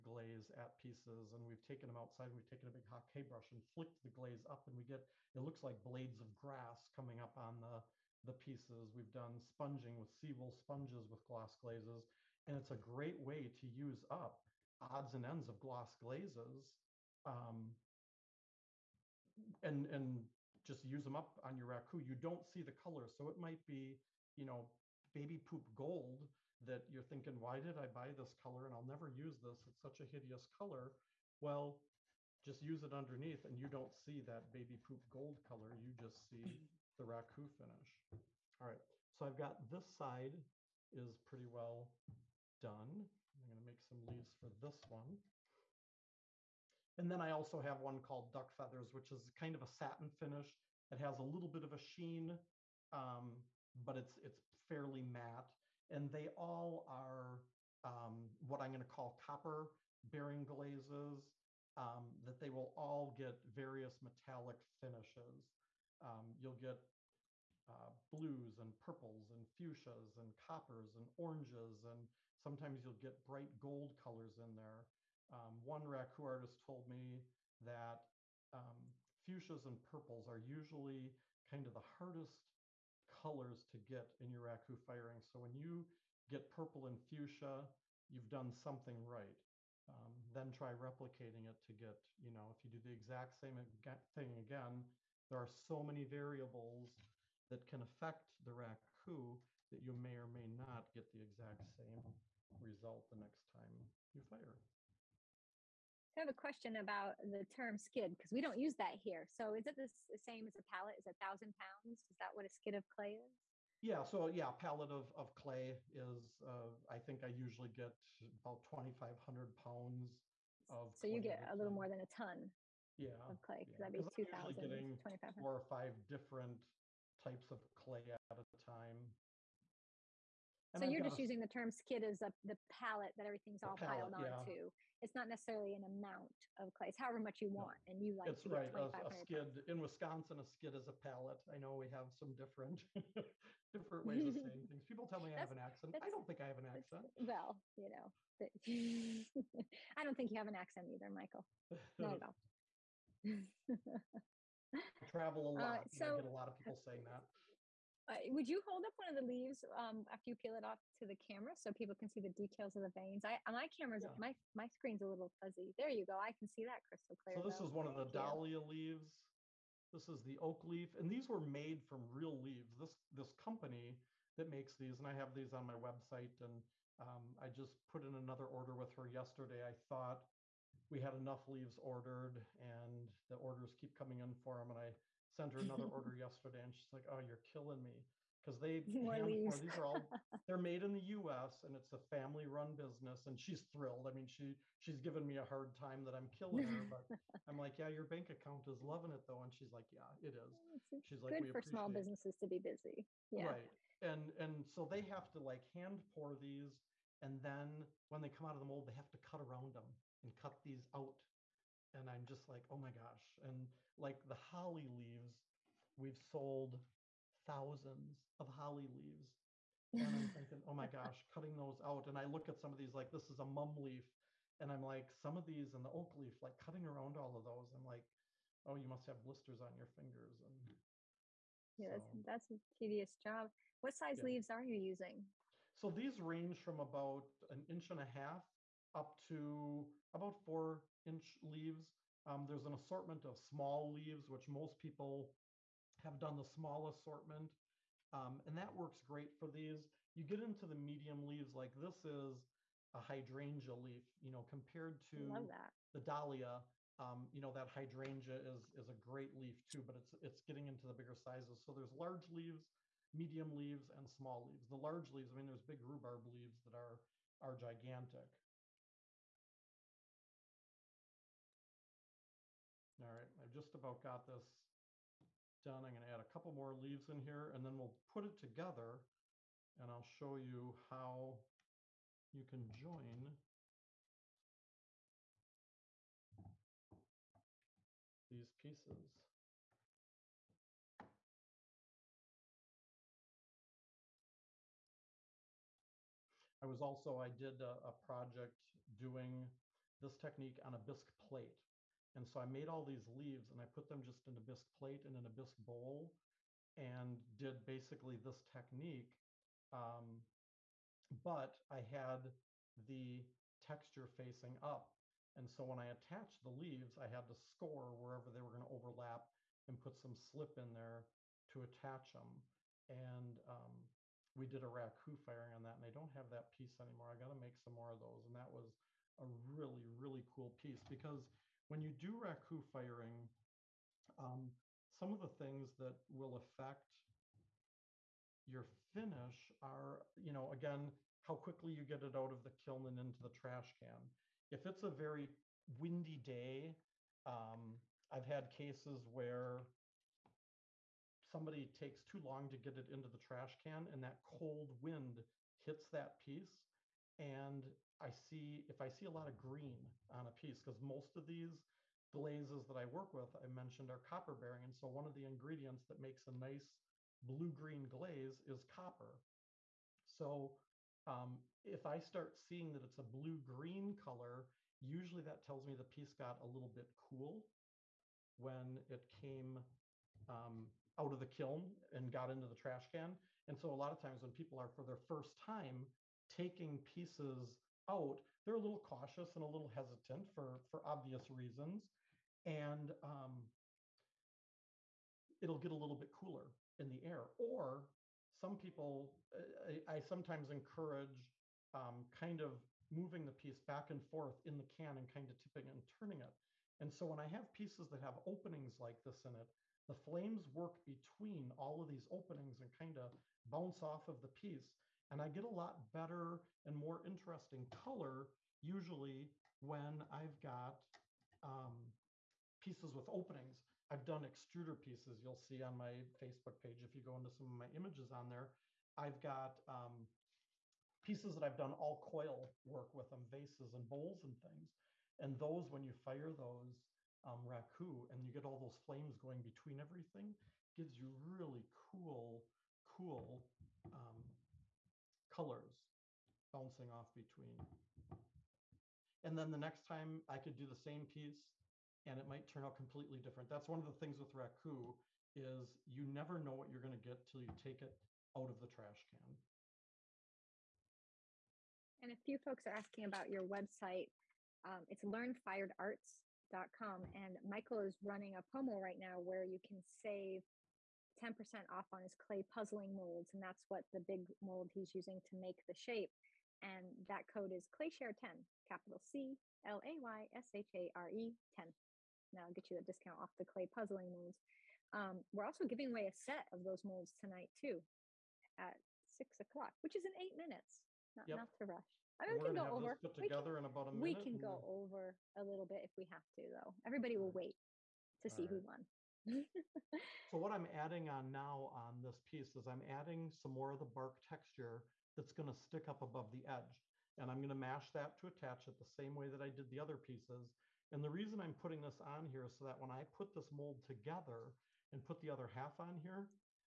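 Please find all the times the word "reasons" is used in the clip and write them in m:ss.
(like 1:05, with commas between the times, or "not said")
6:31, 8:31.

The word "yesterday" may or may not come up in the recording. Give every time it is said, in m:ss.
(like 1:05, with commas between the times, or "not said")
2:59, 3:06.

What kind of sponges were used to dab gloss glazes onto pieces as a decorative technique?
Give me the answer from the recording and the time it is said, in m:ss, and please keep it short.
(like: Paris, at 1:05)
Seawool sponges, at 0:10.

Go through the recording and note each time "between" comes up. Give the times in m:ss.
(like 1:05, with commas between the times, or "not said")
6:50, 7:19, 7:27.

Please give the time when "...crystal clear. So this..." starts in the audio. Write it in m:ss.
2:46.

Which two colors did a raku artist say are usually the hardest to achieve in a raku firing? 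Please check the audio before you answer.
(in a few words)
Fuchsias and purples.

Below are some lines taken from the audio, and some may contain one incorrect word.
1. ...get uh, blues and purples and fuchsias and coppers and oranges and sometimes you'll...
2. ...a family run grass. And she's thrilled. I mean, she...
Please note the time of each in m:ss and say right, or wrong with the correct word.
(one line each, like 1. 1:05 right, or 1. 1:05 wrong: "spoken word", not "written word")
1. 1:06 right
2. 3:11 wrong: "business", not "grass".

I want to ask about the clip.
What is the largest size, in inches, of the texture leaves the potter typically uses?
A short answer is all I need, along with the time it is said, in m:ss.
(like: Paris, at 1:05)
4 inches, at 4:00.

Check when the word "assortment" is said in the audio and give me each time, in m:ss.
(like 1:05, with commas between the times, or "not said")
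4:02, 4:06.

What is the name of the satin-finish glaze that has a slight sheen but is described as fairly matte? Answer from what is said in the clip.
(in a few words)
Duck Feathers.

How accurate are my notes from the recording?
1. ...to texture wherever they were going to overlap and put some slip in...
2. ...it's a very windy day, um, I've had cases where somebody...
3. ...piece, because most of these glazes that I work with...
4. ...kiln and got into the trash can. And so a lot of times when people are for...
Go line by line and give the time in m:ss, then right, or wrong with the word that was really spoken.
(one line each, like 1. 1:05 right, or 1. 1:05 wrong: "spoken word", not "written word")
1. 5:17 wrong: "score", not "texture"
2. 5:44 right
3. 6:00 right
4. 6:21 right.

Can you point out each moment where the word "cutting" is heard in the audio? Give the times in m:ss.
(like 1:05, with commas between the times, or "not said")
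3:41, 3:46.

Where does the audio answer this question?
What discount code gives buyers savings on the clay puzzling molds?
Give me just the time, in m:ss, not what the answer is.
7:57.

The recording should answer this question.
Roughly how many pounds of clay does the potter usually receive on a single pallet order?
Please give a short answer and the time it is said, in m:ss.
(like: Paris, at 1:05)
2,500 pounds, at 1:58.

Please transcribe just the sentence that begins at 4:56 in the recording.
I was also, I did a, a project doing this technique on a bisque plate.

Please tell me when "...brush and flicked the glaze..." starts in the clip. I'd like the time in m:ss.
0:03.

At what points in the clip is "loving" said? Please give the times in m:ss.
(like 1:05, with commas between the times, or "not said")
3:18.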